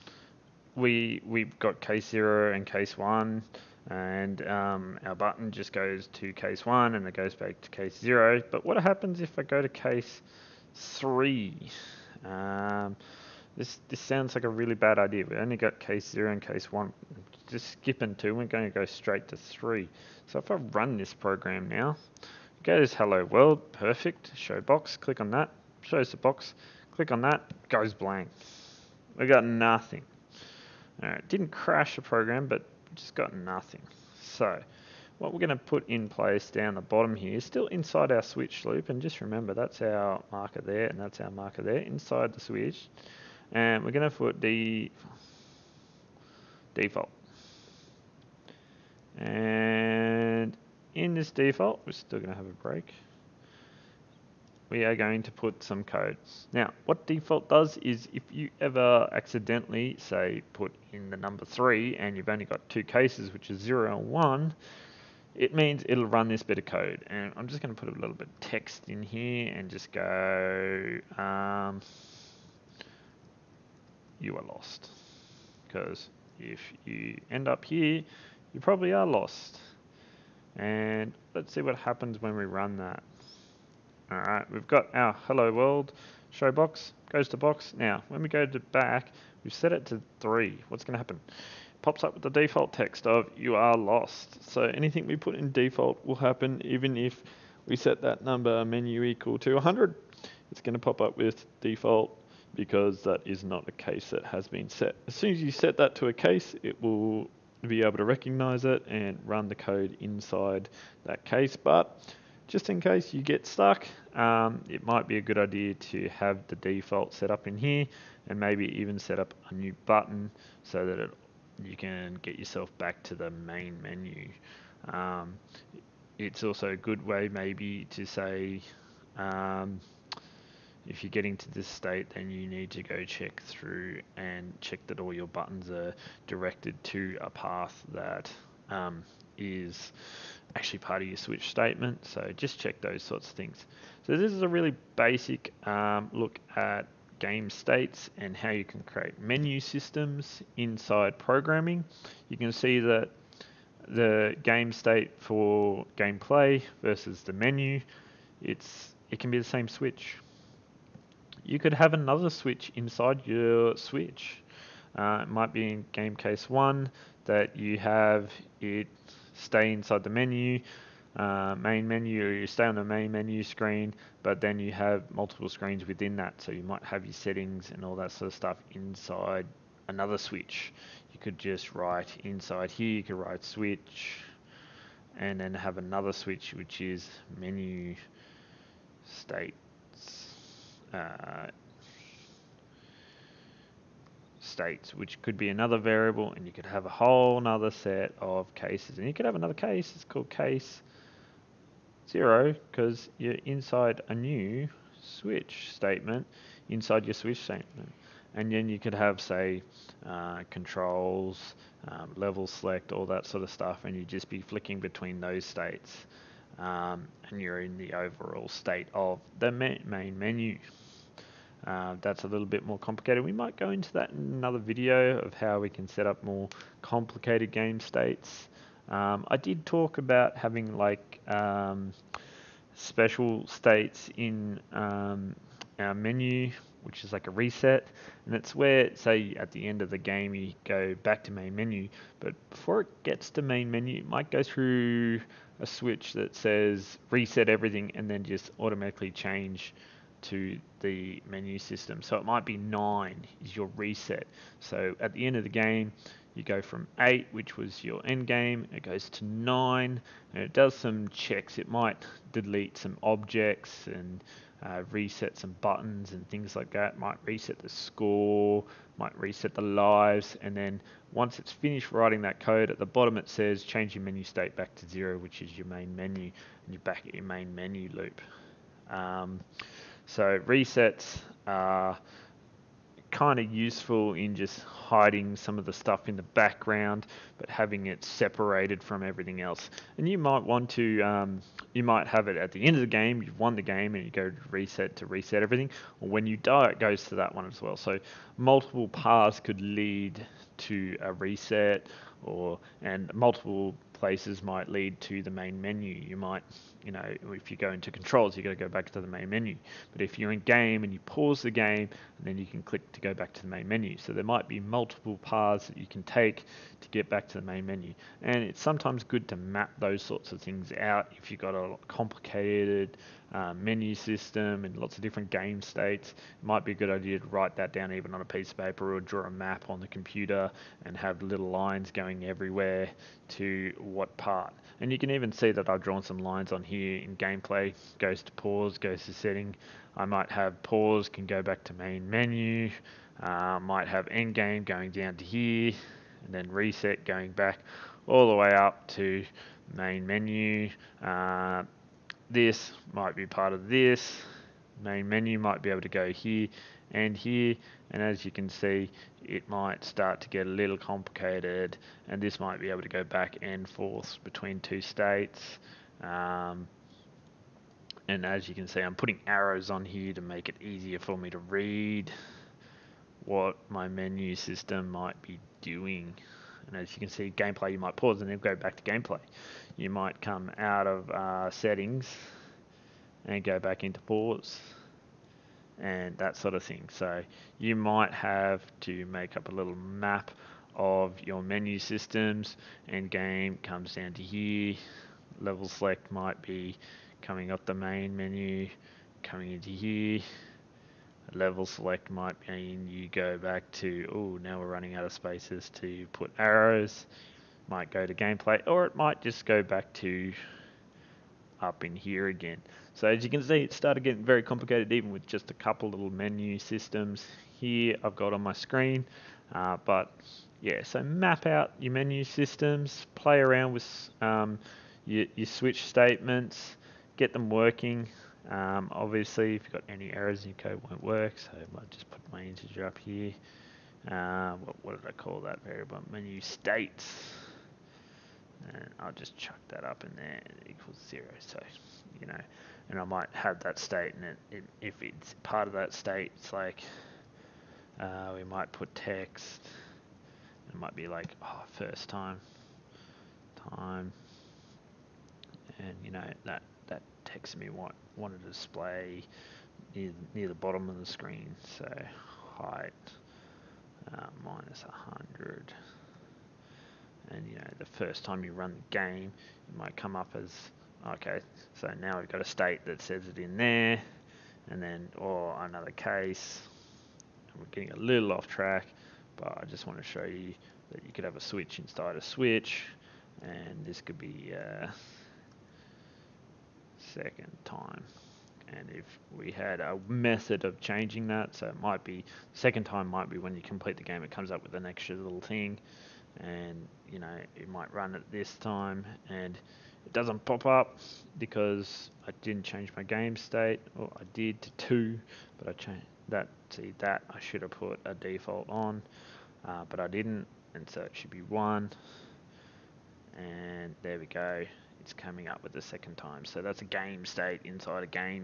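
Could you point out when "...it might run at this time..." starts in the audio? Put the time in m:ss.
8:17.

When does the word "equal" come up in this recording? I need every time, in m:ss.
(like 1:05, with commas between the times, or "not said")
1:39, 7:20.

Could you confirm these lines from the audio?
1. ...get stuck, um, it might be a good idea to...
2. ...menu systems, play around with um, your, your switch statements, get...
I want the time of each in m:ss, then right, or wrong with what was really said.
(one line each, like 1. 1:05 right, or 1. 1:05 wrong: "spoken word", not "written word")
1. 1:53 right
2. 7:01 right.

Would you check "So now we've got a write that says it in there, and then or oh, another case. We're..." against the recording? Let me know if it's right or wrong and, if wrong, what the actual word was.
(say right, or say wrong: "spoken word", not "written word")
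wrong: "state", not "write".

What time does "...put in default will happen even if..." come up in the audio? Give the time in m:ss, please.
1:35.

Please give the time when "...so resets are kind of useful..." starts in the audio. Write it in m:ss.
4:40.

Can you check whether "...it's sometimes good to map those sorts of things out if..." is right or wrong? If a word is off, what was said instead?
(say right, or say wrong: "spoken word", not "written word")
right.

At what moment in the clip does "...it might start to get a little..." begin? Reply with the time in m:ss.
5:59.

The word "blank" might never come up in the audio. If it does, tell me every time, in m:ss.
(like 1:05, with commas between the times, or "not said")
0:27.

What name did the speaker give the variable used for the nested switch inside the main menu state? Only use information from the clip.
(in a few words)
menu states.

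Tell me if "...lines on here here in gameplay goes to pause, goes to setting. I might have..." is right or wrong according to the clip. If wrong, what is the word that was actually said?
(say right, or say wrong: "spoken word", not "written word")
right.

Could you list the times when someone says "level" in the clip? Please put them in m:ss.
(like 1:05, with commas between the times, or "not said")
3:32, 6:35, 6:41.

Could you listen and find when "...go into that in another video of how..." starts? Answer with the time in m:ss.
3:43.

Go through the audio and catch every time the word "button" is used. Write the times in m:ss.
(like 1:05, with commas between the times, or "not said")
0:05, 1:59, 2:15, 4:25.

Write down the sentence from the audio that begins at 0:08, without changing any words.
But what happens if I go to case three?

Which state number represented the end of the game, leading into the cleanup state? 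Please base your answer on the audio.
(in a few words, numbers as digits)
8.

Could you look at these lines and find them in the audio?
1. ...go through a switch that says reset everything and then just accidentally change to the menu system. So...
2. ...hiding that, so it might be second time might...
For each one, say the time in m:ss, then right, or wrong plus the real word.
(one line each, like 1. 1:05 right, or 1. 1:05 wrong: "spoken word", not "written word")
1. 4:04 wrong: "automatically", not "accidentally"
2. 8:10 wrong: "changing", not "hiding".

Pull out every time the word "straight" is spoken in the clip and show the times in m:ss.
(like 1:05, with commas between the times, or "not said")
0:18.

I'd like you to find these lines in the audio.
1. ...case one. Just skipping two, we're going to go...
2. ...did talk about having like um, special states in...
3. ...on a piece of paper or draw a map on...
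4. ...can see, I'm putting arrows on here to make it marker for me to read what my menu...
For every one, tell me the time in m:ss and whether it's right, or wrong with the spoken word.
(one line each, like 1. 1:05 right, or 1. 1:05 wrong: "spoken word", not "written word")
1. 0:16 right
2. 3:49 right
3. 5:28 right
4. 6:08 wrong: "easier", not "marker".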